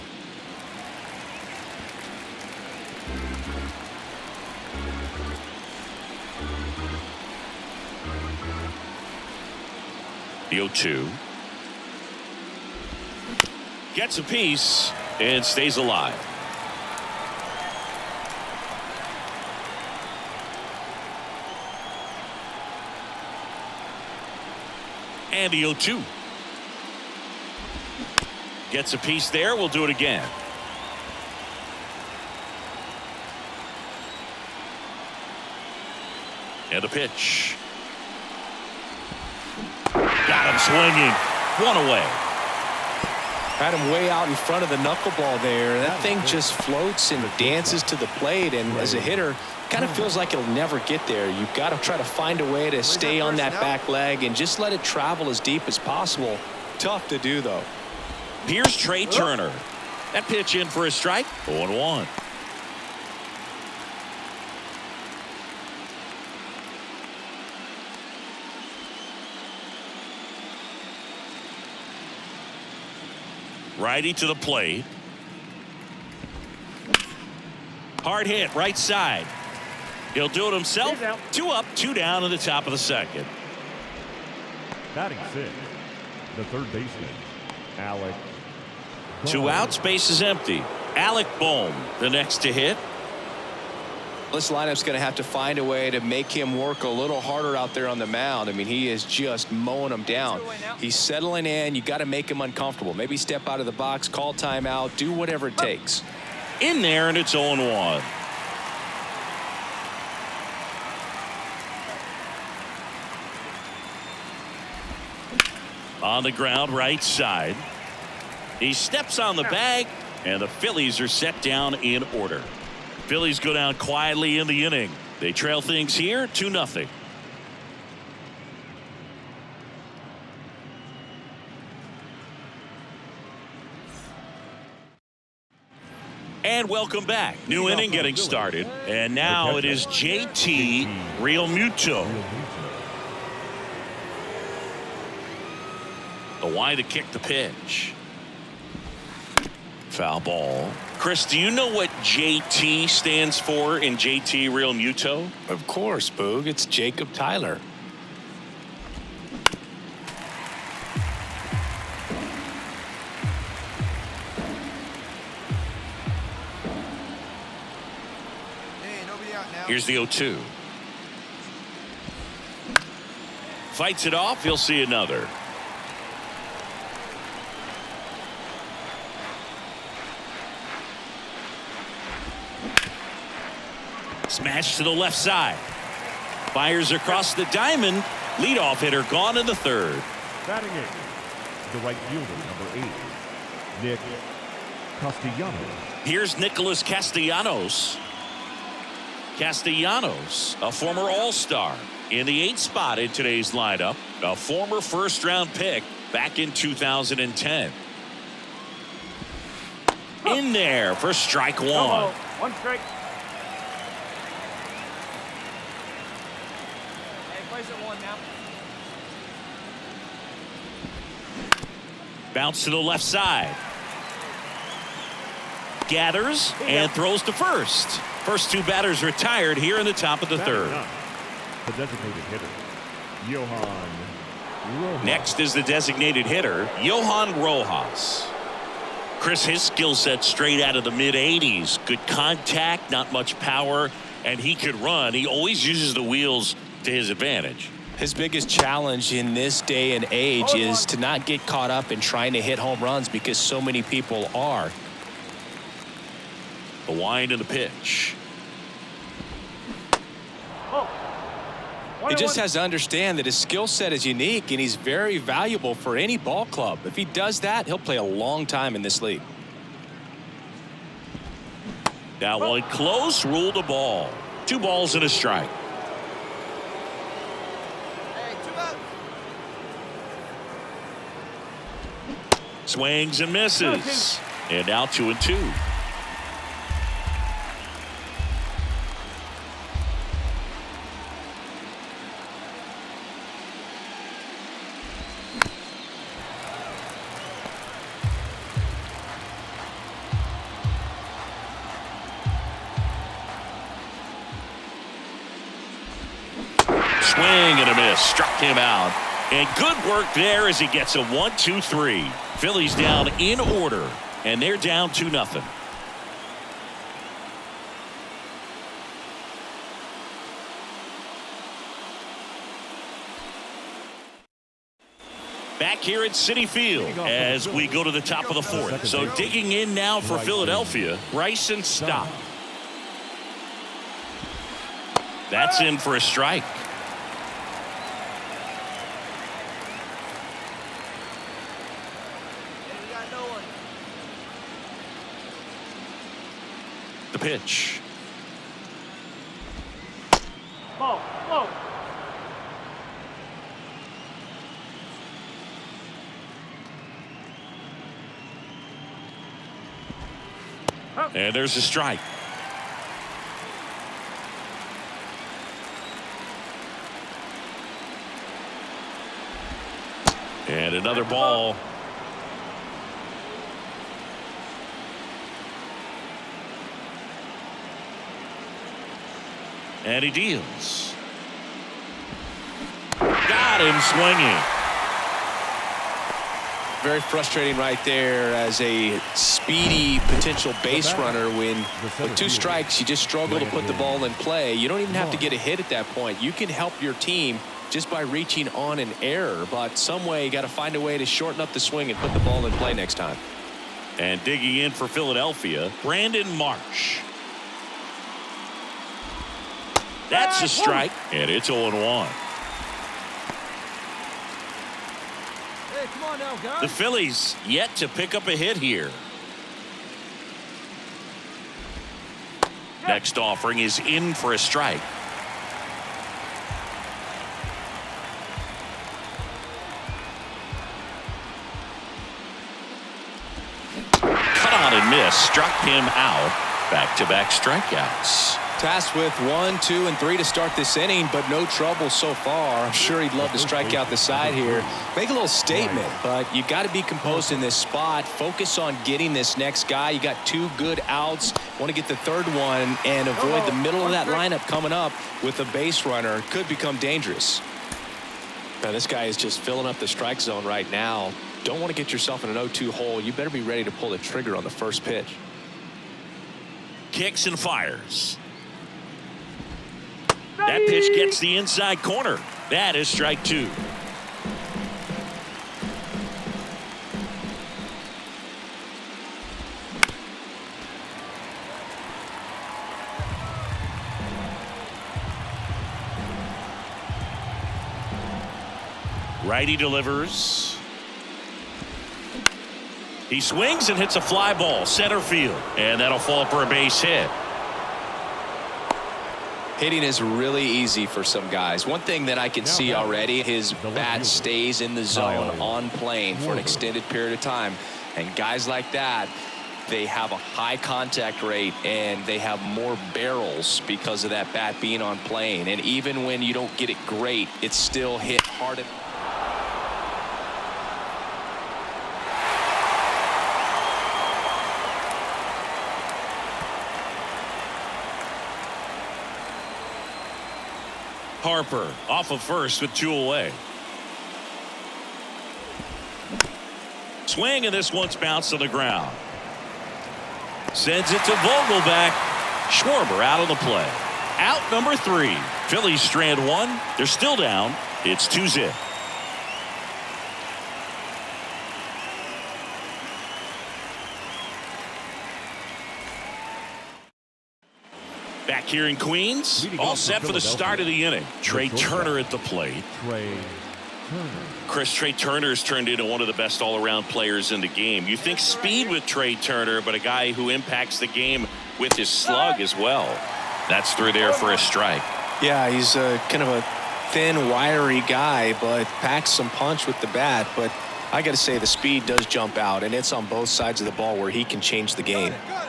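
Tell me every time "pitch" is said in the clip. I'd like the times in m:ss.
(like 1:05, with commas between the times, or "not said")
0:36, 1:00, 2:27, 4:17, 5:47, 7:44, 7:50.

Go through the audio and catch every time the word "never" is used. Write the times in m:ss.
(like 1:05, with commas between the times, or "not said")
0:50.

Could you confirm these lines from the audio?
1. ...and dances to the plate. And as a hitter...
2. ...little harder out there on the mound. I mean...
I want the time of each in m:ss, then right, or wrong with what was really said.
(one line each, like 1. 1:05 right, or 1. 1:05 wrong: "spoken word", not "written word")
1. 0:47 right
2. 1:36 right.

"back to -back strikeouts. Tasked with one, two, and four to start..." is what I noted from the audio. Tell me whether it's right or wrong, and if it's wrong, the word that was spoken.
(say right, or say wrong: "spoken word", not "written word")
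wrong: "three", not "four".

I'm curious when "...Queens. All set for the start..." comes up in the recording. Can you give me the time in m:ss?
9:18.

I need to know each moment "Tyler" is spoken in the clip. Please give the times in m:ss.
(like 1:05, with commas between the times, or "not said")
2:37.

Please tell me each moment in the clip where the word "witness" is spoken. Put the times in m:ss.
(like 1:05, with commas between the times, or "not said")
not said.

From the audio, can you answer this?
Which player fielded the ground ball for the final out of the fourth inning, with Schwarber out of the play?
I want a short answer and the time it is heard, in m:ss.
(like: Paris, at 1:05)
Vogelbach, at 9:01.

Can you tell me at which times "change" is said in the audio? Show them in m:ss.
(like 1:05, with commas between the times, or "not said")
9:44.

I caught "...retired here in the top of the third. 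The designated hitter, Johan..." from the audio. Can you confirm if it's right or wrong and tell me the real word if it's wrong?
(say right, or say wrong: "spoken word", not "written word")
right.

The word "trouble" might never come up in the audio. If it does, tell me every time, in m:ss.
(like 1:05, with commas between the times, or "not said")
7:21.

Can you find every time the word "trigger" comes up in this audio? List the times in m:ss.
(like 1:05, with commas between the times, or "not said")
7:43.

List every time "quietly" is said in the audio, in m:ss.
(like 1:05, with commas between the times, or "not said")
2:03.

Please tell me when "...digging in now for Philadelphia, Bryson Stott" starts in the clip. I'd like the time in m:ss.
5:29.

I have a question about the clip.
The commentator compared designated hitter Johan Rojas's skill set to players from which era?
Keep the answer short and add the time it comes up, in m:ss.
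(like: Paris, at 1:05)
the mid 80s, at 4:00.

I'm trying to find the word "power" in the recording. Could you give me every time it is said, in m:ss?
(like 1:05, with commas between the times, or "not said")
4:03.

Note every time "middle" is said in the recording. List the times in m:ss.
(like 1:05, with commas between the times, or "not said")
7:33.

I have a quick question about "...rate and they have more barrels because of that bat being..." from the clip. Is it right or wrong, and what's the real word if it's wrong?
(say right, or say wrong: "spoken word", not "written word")
right.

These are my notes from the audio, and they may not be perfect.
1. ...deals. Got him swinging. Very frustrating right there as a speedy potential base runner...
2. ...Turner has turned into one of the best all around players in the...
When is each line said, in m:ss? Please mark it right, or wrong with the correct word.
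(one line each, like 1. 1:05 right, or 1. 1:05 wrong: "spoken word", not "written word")
1. 6:20 right
2. 9:24 right.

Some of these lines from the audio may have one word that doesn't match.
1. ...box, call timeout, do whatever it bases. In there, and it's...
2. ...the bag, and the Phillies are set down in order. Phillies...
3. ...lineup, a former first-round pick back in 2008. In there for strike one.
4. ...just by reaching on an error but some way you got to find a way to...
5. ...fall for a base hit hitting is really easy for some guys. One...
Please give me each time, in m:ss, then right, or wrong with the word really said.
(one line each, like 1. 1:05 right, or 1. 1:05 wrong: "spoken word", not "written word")
1. 1:43 wrong: "takes", not "bases"
2. 1:59 right
3. 3:23 wrong: "2010", not "2008"
4. 6:37 right
5. 8:15 right.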